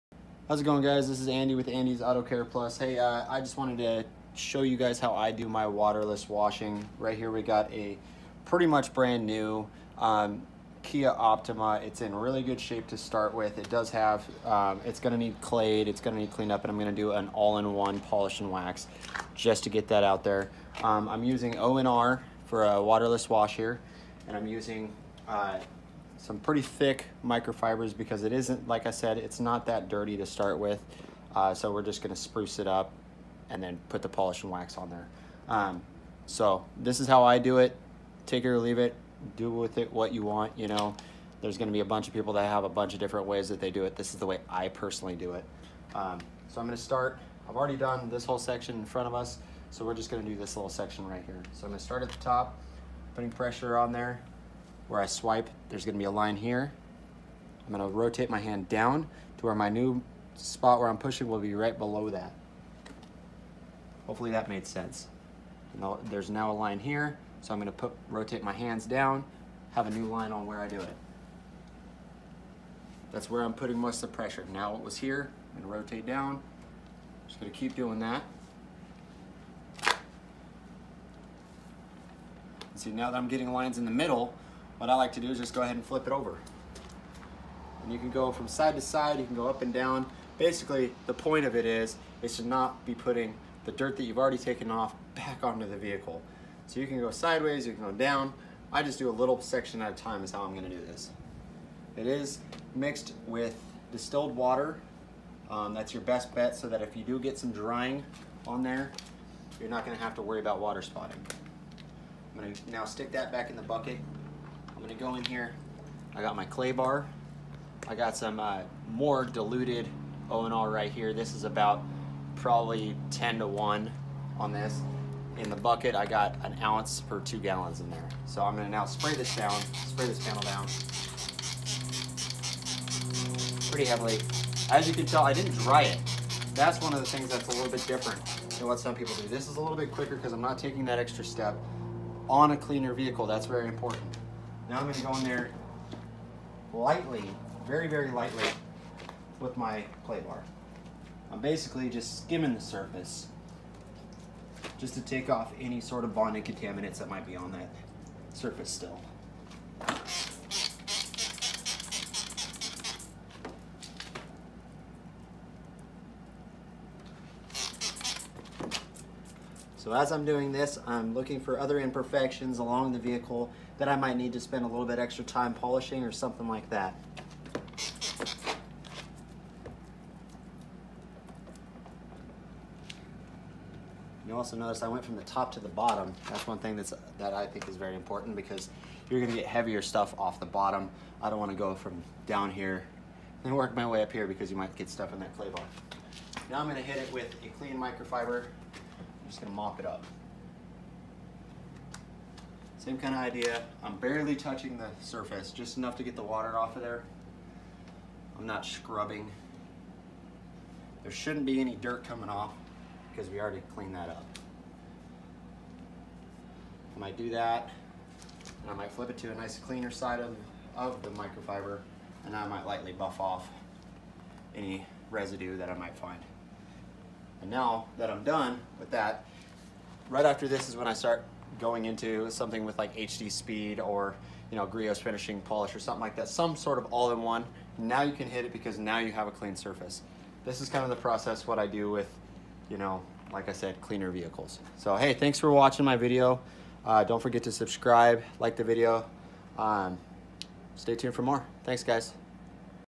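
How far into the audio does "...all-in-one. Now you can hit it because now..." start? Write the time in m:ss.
3:56.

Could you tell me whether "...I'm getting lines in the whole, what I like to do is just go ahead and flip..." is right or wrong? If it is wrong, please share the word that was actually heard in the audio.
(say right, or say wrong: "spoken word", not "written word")
wrong: "middle", not "whole".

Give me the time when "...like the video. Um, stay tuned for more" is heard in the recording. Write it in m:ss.
4:08.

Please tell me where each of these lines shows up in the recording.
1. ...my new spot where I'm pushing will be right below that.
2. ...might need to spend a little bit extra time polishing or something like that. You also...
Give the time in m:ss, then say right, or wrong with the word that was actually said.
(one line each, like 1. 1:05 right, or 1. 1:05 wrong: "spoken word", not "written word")
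1. 0:59 right
2. 2:53 right.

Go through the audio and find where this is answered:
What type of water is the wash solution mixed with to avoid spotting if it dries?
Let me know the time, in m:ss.
1:43.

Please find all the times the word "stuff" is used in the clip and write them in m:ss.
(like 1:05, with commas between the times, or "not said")
3:09, 3:14.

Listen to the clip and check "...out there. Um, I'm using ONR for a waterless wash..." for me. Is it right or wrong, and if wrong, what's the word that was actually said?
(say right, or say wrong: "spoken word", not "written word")
right.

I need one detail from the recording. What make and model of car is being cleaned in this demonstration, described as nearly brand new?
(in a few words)
Kia Optima.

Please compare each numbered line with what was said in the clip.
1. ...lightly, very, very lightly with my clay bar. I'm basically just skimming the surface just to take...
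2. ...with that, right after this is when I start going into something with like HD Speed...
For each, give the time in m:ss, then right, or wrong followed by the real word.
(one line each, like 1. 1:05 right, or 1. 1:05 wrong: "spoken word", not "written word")
1. 2:26 right
2. 3:48 right.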